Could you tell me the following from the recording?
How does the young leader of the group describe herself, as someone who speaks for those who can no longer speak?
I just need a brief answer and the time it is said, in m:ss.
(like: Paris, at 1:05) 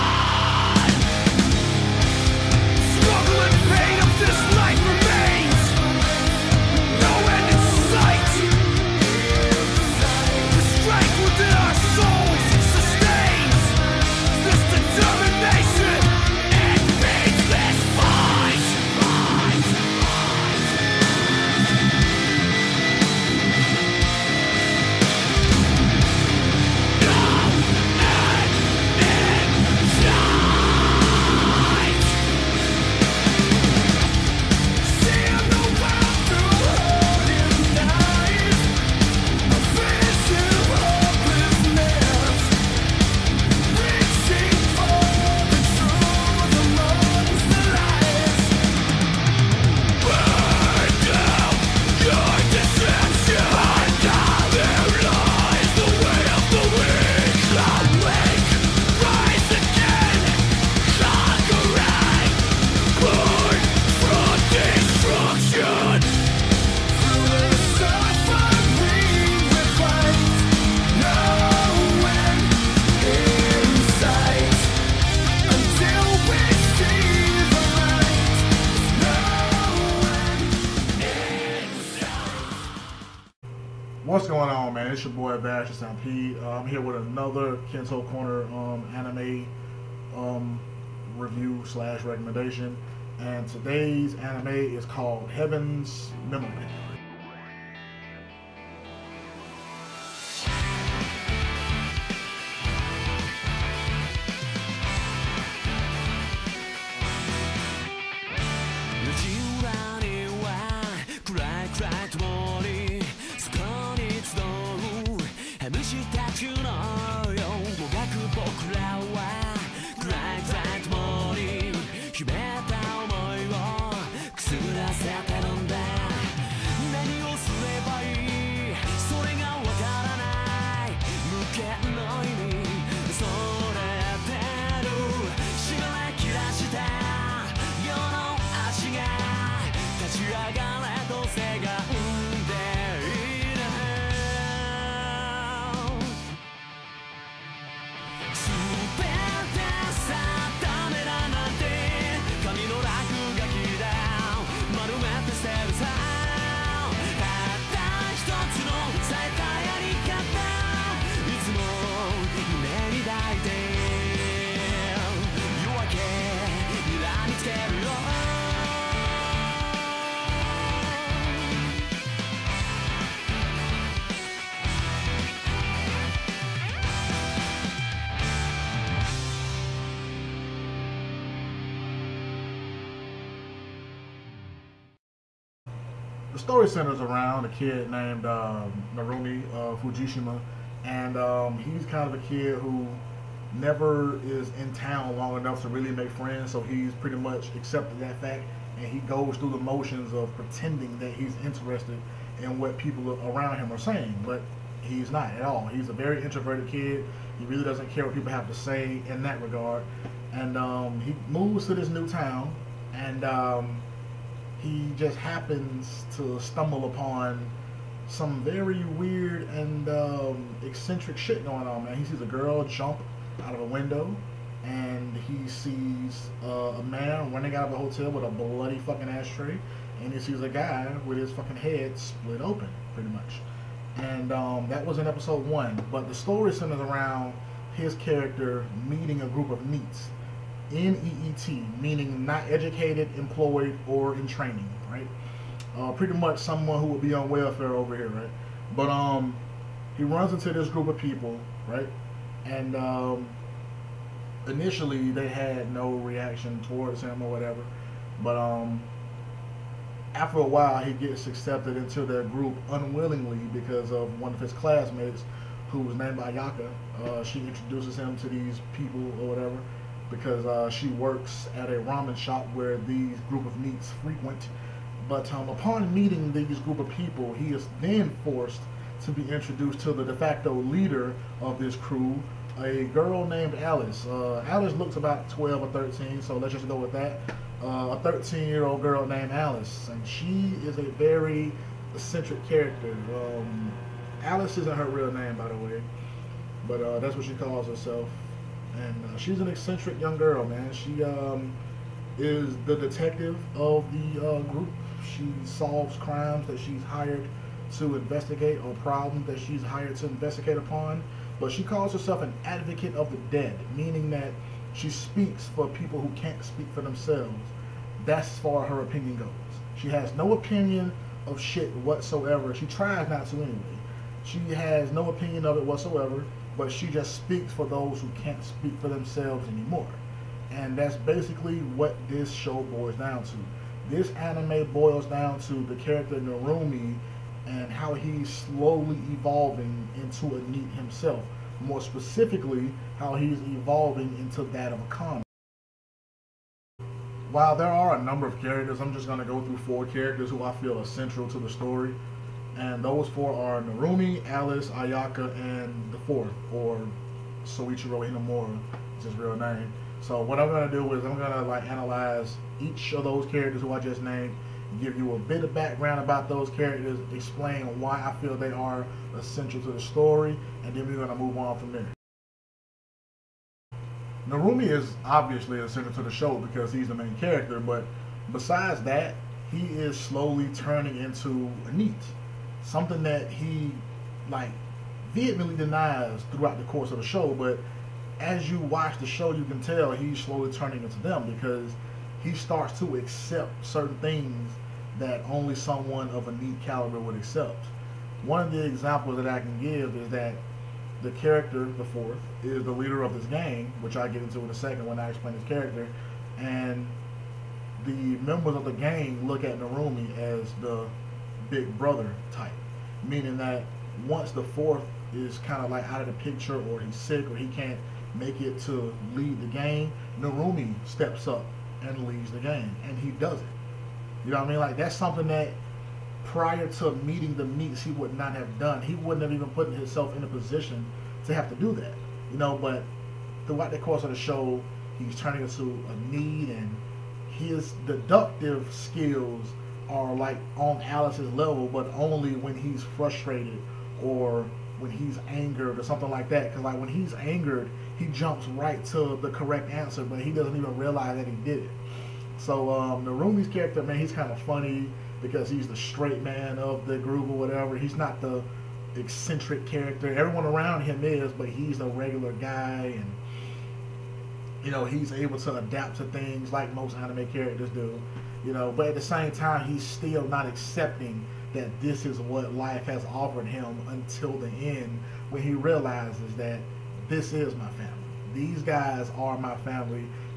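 advocate of the dead, at 5:12.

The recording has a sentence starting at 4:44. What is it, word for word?
Uh, Alice looks about 12 or 13, so let's just go with that.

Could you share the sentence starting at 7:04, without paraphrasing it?
Like that's something that prior to meeting the NEETs he would not have done.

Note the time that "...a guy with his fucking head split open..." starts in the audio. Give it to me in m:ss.
3:50.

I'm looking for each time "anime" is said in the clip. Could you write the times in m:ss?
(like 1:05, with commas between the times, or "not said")
1:28, 1:34, 5:34, 7:46.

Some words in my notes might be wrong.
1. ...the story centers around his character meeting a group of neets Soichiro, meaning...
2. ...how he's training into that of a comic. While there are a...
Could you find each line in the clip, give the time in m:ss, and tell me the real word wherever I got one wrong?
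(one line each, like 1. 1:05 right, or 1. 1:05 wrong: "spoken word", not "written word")
1. 3:56 wrong: "NEET", not "Soichiro"
2. 5:42 wrong: "evolving", not "training".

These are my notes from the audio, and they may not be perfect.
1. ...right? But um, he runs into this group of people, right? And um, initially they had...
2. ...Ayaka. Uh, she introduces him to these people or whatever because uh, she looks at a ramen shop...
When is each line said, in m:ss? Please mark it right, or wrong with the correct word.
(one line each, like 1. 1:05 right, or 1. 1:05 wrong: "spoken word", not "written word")
1. 4:08 right
2. 4:26 wrong: "works", not "looks".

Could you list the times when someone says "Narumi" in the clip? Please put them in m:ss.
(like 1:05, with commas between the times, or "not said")
3:08, 5:36, 5:53, 6:14, 6:49, 7:00, 7:33.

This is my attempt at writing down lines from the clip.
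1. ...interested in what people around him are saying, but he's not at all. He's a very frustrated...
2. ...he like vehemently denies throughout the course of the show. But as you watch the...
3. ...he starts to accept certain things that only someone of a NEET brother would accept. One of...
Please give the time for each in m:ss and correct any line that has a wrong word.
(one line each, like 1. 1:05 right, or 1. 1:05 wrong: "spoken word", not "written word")
1. 3:21 wrong: "introverted", not "frustrated"
2. 6:23 right
3. 6:32 wrong: "caliber", not "brother".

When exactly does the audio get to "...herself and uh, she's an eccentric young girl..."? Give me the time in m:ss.
4:57.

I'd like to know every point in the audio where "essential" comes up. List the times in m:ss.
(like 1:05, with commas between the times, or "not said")
6:09, 6:15.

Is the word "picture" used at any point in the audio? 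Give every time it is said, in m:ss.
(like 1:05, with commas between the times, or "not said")
6:56.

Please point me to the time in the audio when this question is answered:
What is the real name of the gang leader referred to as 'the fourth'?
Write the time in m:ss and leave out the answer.
5:57.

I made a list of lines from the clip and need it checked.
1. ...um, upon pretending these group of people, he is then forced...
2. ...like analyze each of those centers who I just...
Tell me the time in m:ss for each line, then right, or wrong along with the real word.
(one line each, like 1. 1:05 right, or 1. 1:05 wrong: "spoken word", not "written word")
1. 4:35 wrong: "meeting", not "pretending"
2. 6:01 wrong: "characters", not "centers".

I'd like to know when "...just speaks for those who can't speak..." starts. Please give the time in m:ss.
5:26.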